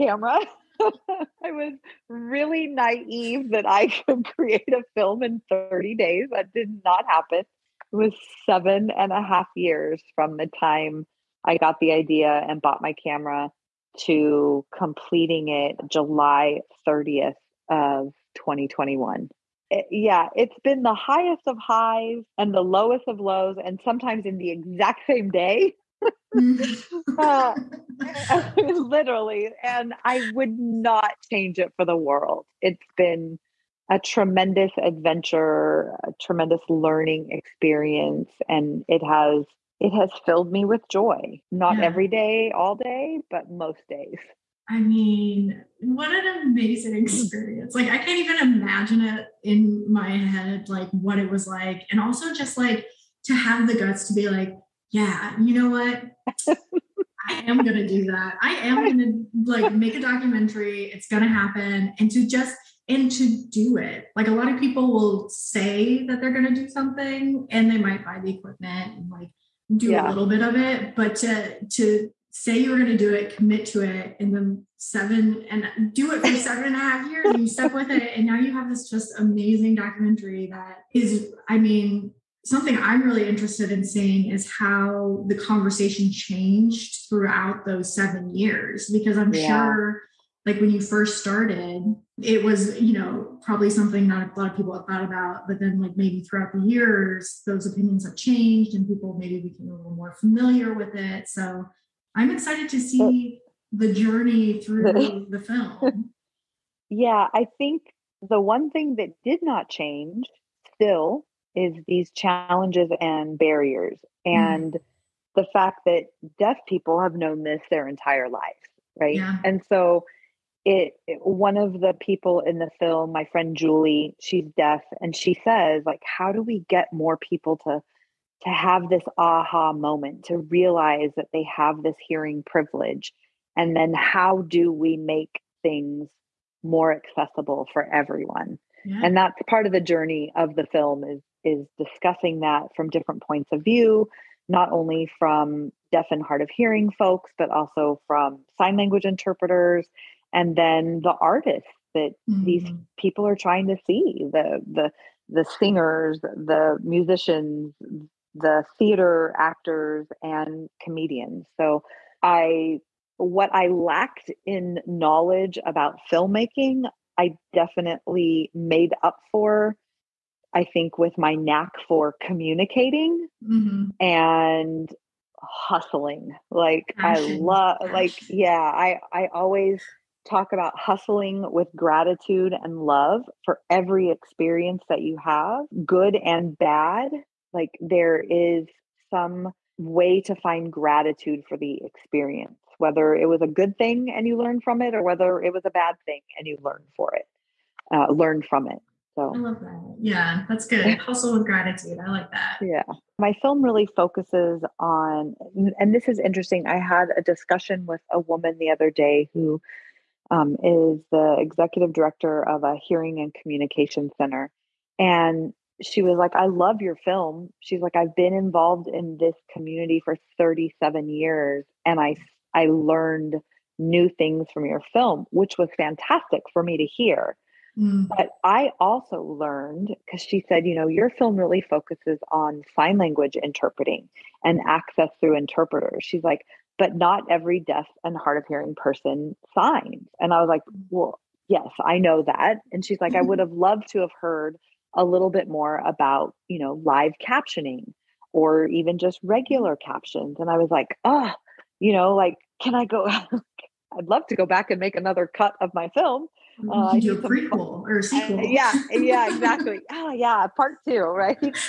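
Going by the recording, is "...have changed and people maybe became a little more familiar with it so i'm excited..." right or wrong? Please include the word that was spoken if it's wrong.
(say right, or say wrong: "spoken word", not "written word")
right.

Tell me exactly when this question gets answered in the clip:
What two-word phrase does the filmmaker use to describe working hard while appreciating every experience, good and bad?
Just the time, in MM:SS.
03:00.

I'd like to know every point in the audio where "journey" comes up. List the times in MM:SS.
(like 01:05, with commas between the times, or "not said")
01:43, 02:19.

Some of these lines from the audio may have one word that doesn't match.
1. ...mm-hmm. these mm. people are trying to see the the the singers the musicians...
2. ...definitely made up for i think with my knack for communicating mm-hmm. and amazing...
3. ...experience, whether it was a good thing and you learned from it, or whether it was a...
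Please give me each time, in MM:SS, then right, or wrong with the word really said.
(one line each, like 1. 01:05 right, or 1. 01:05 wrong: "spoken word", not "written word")
1. 02:32 right
2. 02:47 wrong: "hustling", not "amazing"
3. 03:11 right.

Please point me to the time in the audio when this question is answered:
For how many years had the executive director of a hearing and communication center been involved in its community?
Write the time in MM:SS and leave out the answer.
03:40.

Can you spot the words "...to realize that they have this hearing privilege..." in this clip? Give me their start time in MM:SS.
02:10.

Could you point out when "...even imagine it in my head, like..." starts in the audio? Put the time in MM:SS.
00:48.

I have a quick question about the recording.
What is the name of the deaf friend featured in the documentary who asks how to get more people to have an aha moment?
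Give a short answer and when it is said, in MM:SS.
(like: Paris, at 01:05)
Julie, at 02:03.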